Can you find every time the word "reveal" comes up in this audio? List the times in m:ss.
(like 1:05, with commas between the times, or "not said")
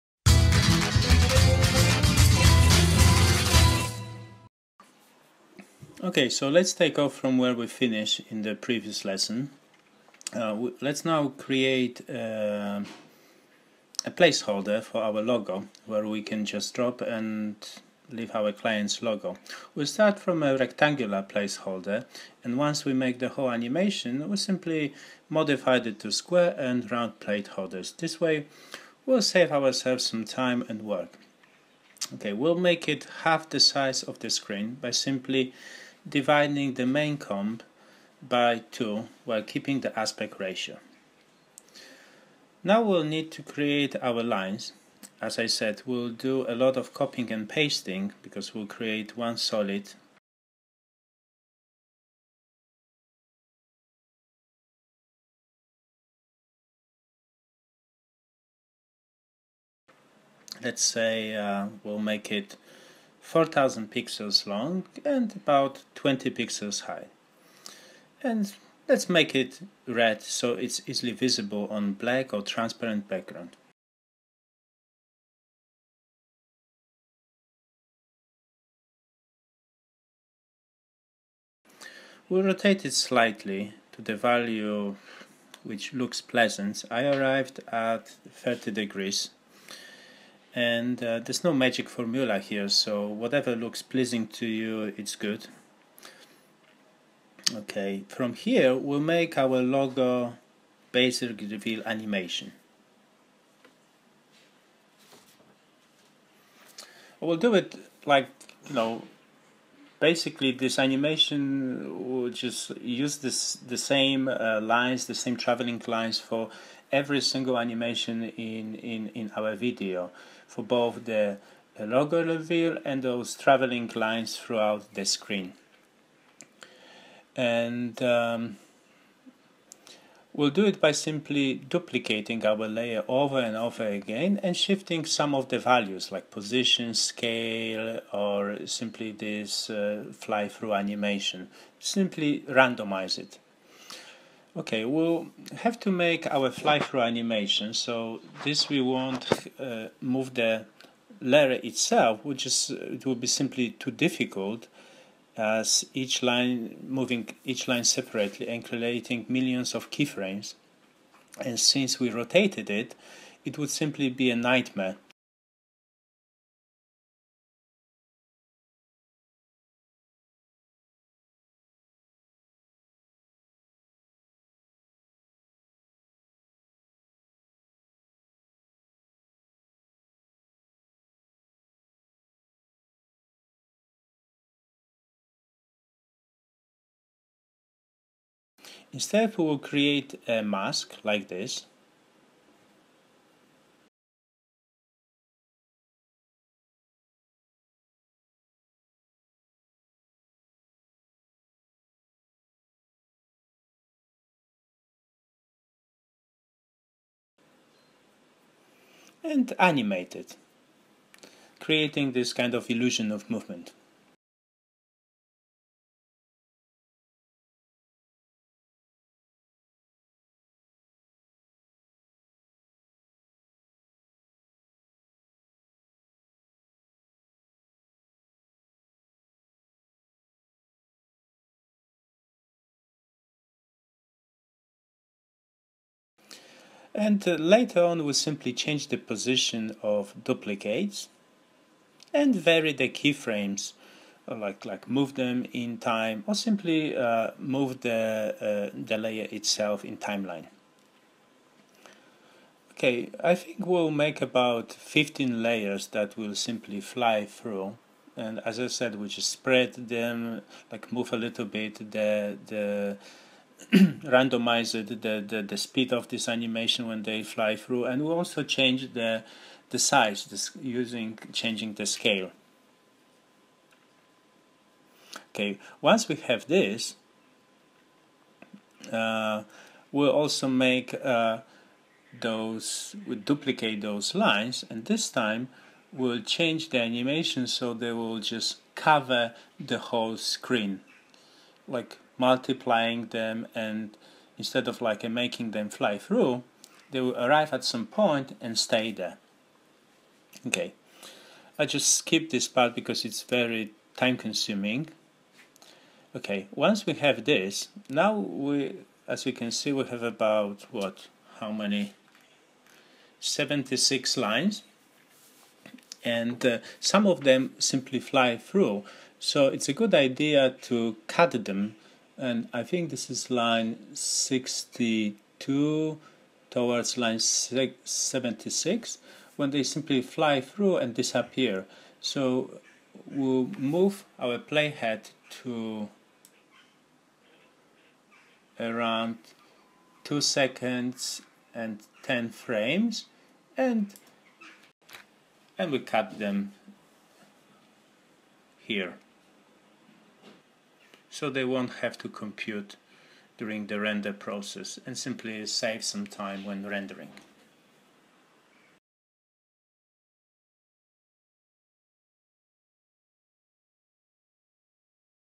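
1:41, 2:02.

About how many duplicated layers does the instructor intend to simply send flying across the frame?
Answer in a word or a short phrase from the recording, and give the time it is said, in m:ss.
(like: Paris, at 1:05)
15, at 4:14.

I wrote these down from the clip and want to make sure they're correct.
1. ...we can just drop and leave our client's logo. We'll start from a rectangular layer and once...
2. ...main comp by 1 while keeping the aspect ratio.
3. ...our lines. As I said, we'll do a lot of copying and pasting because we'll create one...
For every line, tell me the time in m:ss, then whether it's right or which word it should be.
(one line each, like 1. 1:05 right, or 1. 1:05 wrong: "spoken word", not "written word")
1. 0:16 wrong: "placeholder", not "layer"
2. 0:36 wrong: "2", not "1"
3. 0:44 right.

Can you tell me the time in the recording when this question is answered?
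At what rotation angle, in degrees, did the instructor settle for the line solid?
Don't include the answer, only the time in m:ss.
1:28.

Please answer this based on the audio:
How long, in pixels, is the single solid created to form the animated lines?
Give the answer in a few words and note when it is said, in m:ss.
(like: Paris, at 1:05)
4000 pixels, at 1:03.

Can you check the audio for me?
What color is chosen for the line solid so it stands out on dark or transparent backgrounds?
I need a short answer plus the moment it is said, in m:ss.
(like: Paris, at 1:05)
Red, at 1:09.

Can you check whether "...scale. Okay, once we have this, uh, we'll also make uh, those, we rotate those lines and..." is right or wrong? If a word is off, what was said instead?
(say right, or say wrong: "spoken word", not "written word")
wrong: "duplicate", not "rotate".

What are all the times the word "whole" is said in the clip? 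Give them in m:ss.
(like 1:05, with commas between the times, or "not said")
0:23, 4:49.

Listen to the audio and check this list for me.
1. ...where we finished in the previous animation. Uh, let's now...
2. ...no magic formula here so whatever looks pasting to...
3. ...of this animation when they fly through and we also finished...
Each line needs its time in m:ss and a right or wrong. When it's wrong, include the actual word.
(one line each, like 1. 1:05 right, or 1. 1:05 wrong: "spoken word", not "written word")
1. 0:07 wrong: "lesson", not "animation"
2. 1:31 wrong: "pleasing", not "pasting"
3. 4:25 wrong: "changed", not "finished".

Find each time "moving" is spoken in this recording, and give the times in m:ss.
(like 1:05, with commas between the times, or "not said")
2:36.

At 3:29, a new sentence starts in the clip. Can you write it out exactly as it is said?
and animate it, creating this kind of illusion of movement.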